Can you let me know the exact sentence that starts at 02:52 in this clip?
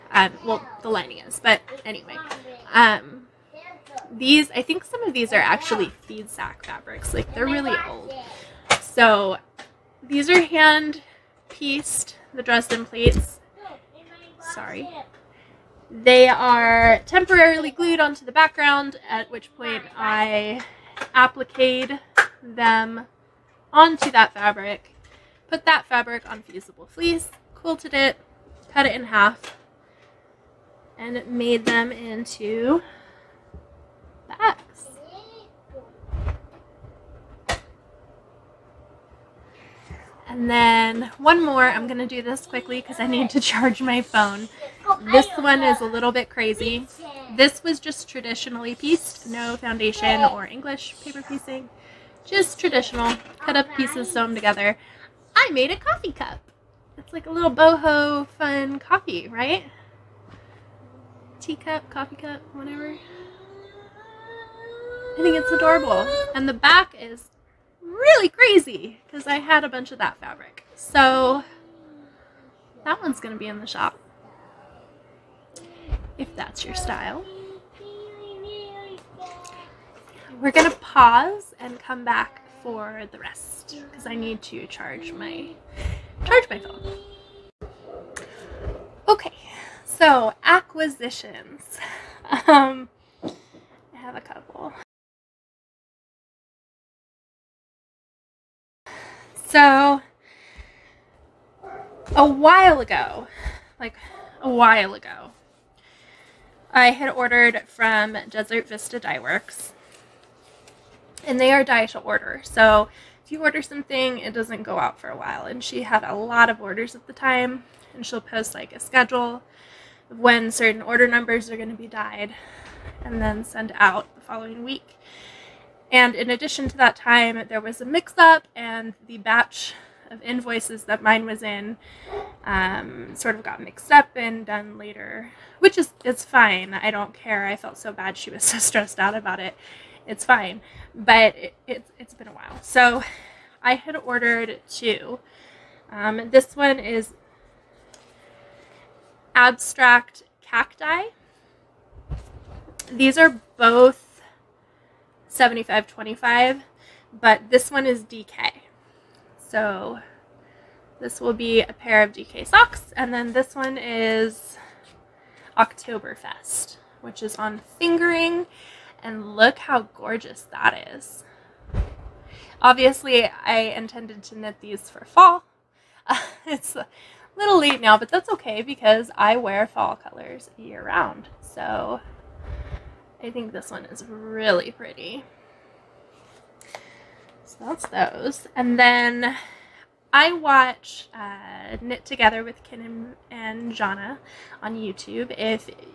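Obviously, I intended to knit these for fall.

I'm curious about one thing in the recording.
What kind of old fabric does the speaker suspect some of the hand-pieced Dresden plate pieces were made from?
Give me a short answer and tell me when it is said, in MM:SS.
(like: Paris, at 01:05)
feed sack fabrics, at 00:06.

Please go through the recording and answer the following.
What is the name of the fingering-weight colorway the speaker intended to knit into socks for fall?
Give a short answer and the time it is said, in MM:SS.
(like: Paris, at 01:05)
Oktoberfest, at 02:45.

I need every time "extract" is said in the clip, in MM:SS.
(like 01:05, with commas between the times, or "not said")
not said.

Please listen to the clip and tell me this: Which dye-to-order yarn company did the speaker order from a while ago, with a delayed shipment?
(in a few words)
Desert Vista Dye Works.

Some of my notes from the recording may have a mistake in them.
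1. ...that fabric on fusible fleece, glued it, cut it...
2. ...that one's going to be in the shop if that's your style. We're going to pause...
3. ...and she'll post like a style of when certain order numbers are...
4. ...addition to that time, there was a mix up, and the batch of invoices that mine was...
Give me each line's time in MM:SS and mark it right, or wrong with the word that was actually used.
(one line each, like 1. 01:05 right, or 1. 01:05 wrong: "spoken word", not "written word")
1. 00:25 wrong: "quilted", not "glued"
2. 01:12 right
3. 01:57 wrong: "schedule", not "style"
4. 02:06 right.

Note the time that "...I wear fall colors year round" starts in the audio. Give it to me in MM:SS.
02:59.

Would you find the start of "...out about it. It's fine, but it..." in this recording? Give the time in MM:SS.
02:18.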